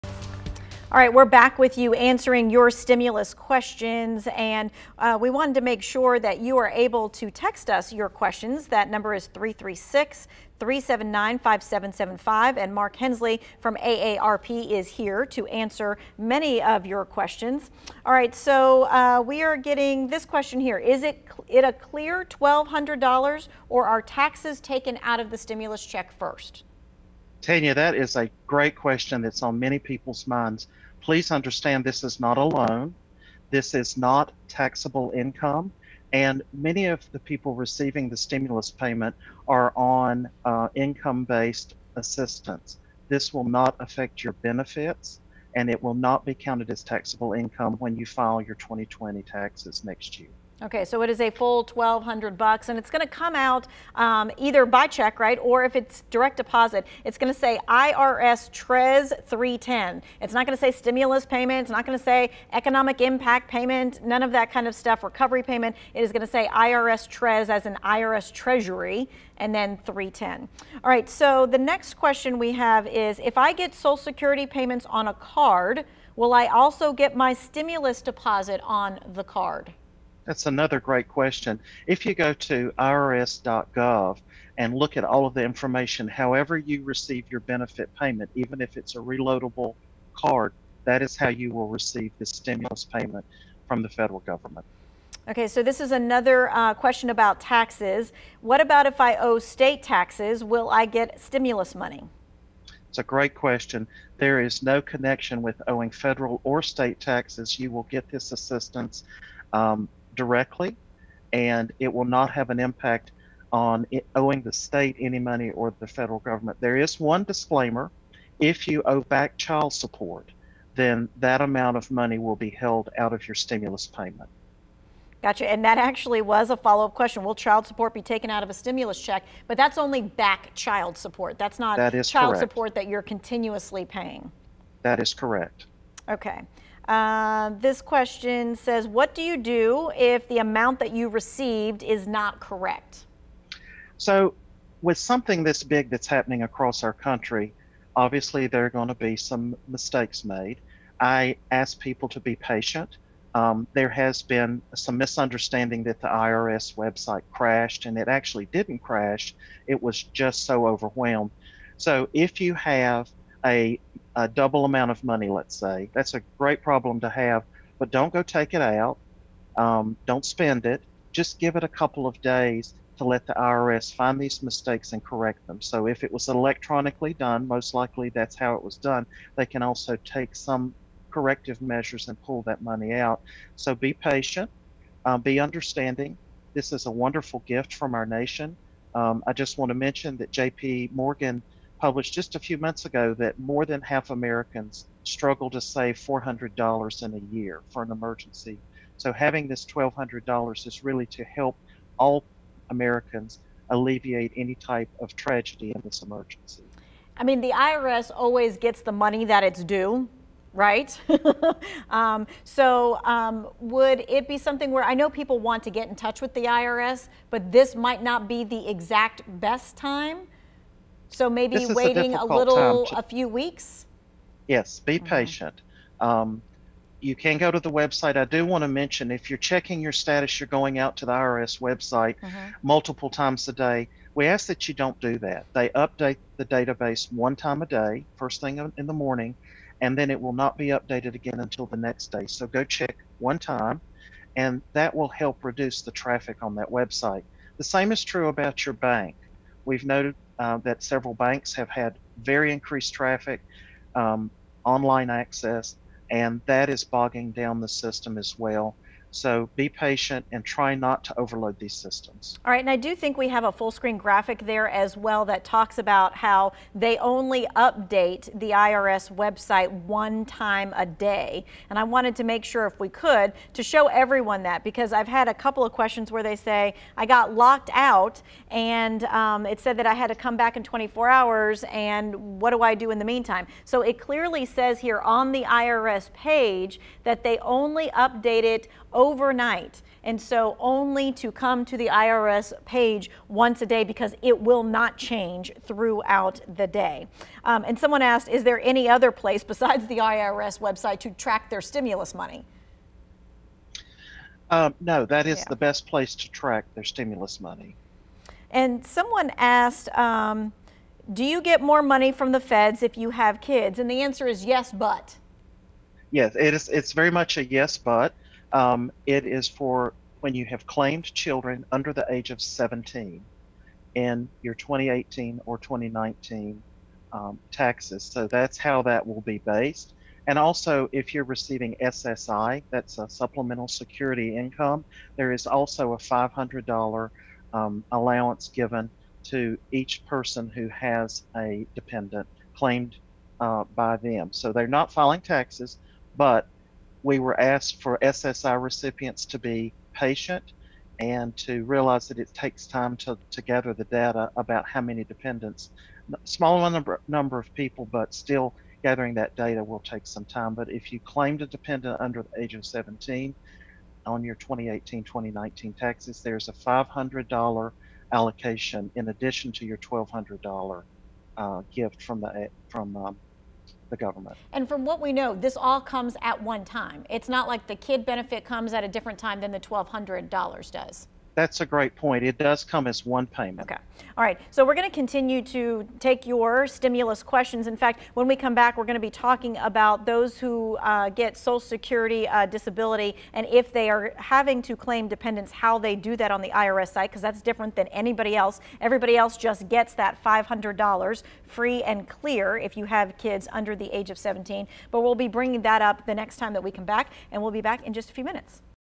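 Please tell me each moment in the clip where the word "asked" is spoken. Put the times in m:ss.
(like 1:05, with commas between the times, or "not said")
4:58, 5:09, 5:47.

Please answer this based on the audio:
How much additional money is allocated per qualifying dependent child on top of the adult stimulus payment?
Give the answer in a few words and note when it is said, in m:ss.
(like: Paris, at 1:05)
$500, at 6:06.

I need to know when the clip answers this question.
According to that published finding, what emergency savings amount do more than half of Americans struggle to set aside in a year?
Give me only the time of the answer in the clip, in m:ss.
3:15.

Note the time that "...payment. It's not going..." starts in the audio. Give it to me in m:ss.
1:01.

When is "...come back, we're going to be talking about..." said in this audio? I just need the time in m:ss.
6:28.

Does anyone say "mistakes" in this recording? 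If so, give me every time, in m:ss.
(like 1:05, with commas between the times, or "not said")
2:29, 2:54.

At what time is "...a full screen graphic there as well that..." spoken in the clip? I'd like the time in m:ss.
4:23.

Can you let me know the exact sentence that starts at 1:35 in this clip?
Okay, so this is another uh, question about taxes.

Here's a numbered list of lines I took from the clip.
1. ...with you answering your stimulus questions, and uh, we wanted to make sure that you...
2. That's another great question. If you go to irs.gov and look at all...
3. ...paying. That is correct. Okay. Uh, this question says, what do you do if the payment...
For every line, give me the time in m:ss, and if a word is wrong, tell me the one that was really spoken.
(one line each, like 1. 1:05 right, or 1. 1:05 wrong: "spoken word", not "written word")
1. 0:01 right
2. 1:20 right
3. 2:13 wrong: "amount", not "payment".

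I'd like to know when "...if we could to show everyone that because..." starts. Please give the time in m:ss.
4:32.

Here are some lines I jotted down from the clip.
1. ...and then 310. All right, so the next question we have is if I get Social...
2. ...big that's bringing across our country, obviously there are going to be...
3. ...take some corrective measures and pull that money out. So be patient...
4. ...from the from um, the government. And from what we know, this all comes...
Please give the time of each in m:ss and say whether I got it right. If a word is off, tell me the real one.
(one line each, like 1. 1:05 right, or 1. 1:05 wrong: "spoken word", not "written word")
1. 1:09 right
2. 2:25 wrong: "happening", not "bringing"
3. 3:00 right
4. 6:12 right.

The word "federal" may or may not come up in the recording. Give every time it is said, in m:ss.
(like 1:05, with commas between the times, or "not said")
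1:33, 1:45, 1:55.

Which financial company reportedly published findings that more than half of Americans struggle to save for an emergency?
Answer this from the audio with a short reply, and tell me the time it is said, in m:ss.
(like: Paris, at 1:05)
JP Morgan, at 3:10.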